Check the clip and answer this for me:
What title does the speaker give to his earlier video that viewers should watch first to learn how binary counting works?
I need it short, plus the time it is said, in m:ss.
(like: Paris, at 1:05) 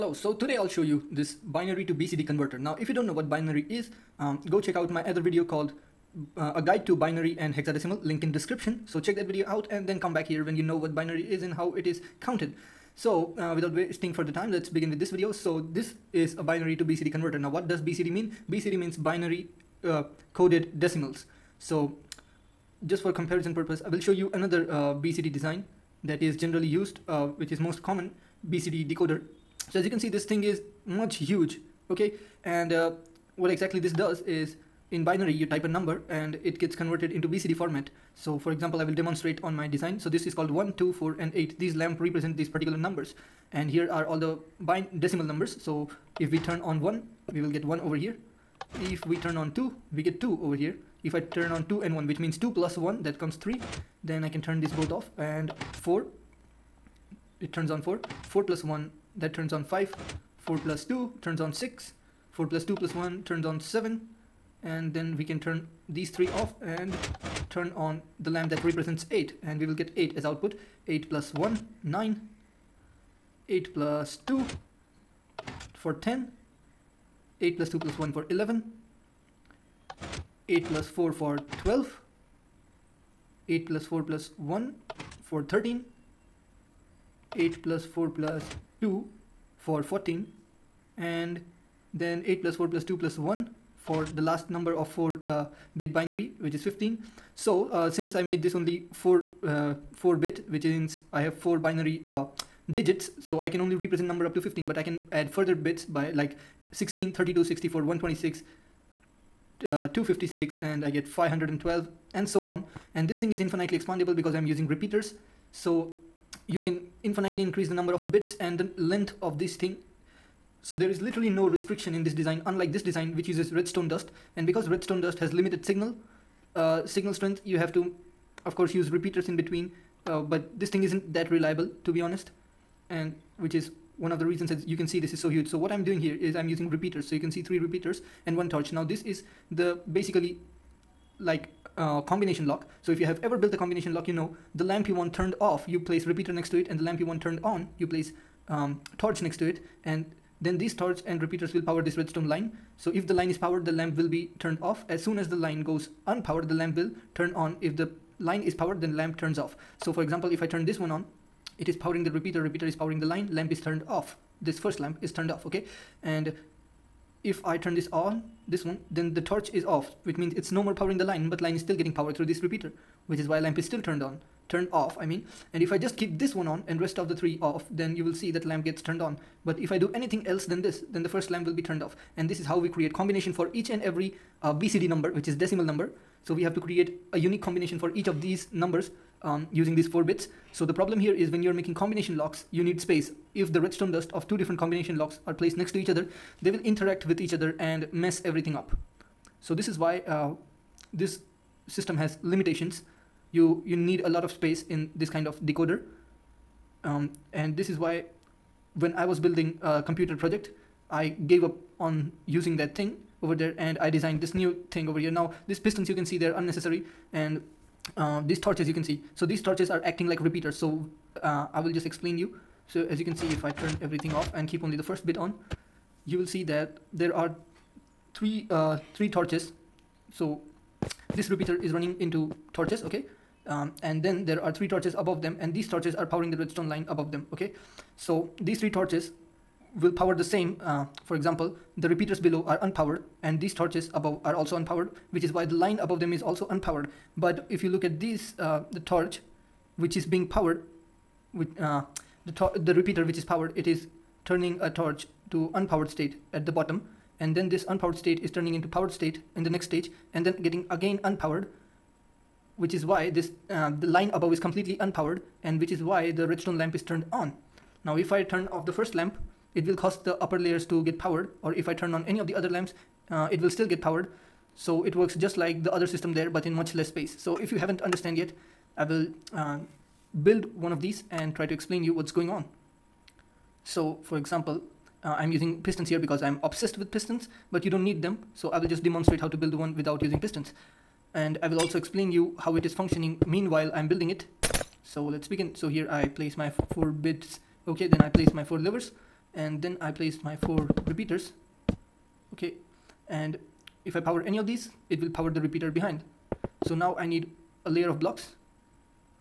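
A guide to binary and hexadecimal, at 0:06.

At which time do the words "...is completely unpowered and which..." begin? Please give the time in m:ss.
4:24.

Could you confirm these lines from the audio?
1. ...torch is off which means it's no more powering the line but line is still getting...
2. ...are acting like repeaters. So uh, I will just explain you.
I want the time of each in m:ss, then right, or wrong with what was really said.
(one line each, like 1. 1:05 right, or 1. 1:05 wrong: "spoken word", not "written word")
1. 2:49 right
2. 3:39 right.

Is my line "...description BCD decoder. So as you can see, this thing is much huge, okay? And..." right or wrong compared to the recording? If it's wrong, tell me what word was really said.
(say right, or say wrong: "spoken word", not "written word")
wrong: "common", not "description".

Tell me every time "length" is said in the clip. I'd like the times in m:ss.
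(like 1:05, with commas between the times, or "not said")
1:58.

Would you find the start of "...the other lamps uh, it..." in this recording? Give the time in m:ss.
4:32.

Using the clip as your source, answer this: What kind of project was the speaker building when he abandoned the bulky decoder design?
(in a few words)
A computer project.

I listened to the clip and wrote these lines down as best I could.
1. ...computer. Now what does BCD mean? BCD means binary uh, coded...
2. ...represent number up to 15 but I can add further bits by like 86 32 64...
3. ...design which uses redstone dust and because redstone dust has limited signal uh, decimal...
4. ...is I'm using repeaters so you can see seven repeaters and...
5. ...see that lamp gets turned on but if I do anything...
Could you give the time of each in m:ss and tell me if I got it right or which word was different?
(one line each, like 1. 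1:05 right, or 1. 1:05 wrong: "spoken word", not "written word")
1. 0:17 wrong: "converter", not "computer"
2. 1:43 wrong: "16", not "86"
3. 2:02 wrong: "signal", not "decimal"
4. 2:16 wrong: "three", not "seven"
5. 2:58 right.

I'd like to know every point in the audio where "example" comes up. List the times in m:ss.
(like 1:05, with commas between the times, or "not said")
0:38, 2:40, 4:01, 4:44.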